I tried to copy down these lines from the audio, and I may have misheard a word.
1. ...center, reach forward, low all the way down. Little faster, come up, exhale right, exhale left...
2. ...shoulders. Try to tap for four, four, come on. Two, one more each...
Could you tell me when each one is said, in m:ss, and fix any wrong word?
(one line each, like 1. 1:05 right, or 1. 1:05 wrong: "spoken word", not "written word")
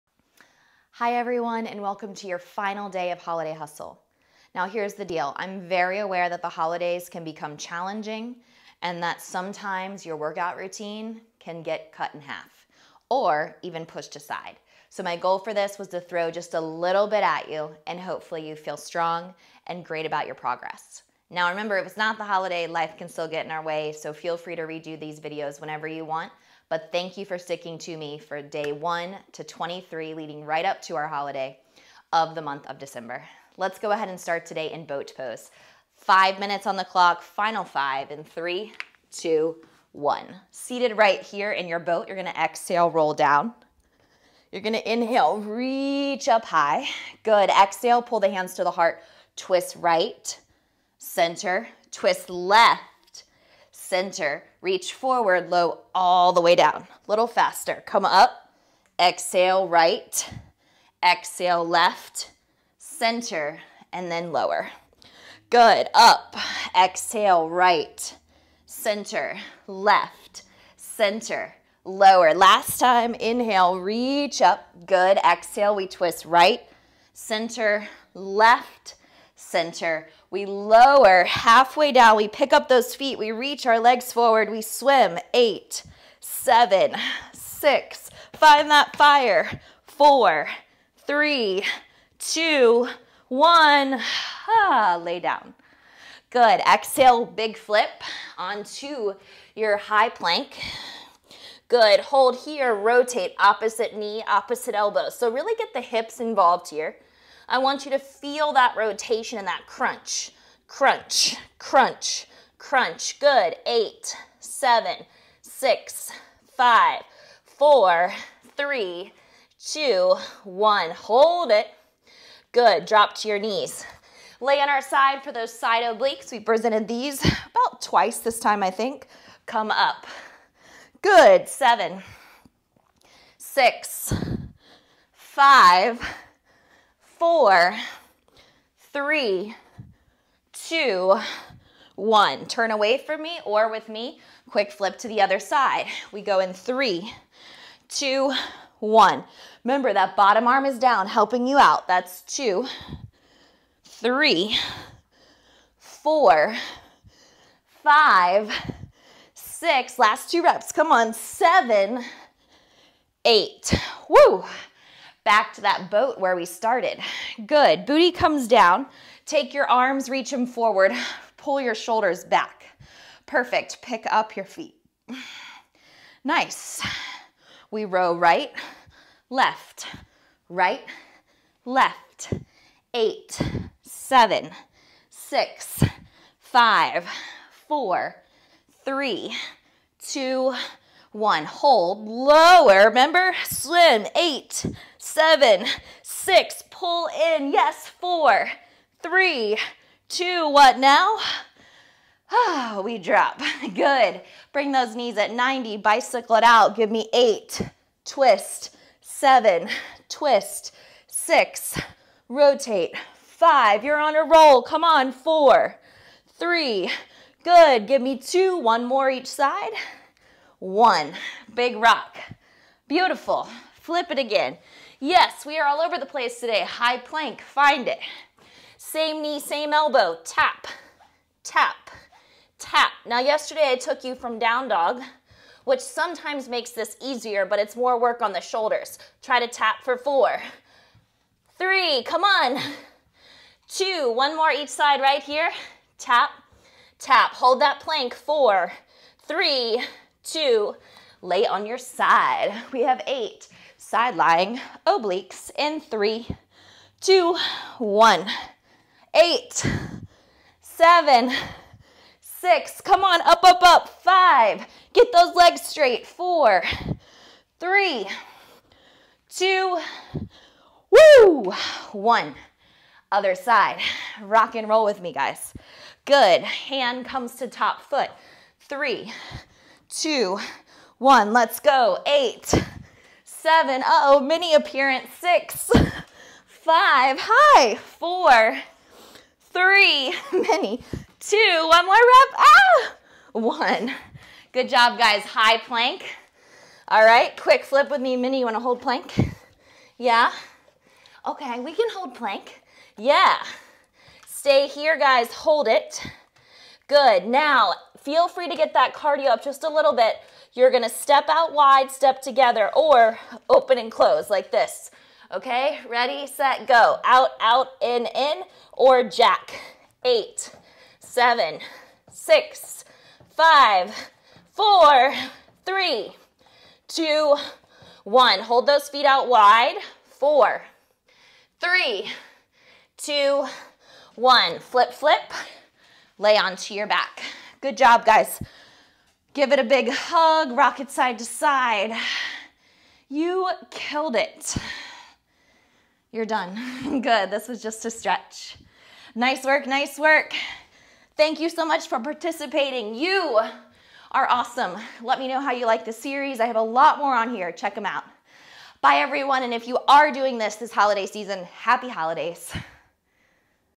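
1. 0:53 right
2. 3:58 wrong: "three", not "four".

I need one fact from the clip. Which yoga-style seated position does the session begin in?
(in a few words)
boat pose.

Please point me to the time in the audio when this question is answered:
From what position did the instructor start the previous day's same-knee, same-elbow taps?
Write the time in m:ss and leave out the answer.
3:54.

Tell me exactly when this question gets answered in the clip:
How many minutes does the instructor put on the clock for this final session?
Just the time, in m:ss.
0:35.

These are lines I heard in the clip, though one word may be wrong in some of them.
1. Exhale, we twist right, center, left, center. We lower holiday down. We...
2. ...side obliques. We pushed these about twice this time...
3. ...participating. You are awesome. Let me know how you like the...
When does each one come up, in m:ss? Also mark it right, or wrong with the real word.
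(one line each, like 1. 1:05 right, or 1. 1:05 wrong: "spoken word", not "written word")
1. 1:15 wrong: "halfway", not "holiday"
2. 2:05 wrong: "presented", not "pushed"
3. 5:51 right.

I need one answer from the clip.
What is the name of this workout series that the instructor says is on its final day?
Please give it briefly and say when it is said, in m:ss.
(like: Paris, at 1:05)
Holiday Hustle, at 0:03.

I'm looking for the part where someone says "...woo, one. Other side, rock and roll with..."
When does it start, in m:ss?
4:30.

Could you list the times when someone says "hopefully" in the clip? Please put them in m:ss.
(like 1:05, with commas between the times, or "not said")
0:17.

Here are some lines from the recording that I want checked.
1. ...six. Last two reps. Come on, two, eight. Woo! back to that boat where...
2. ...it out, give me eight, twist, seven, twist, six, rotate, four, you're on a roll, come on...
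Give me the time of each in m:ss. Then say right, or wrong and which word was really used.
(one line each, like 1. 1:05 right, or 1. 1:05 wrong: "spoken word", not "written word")
1. 2:39 wrong: "seven", not "two"
2. 3:26 wrong: "five", not "four".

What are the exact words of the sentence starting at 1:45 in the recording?
So really get the hips involved here.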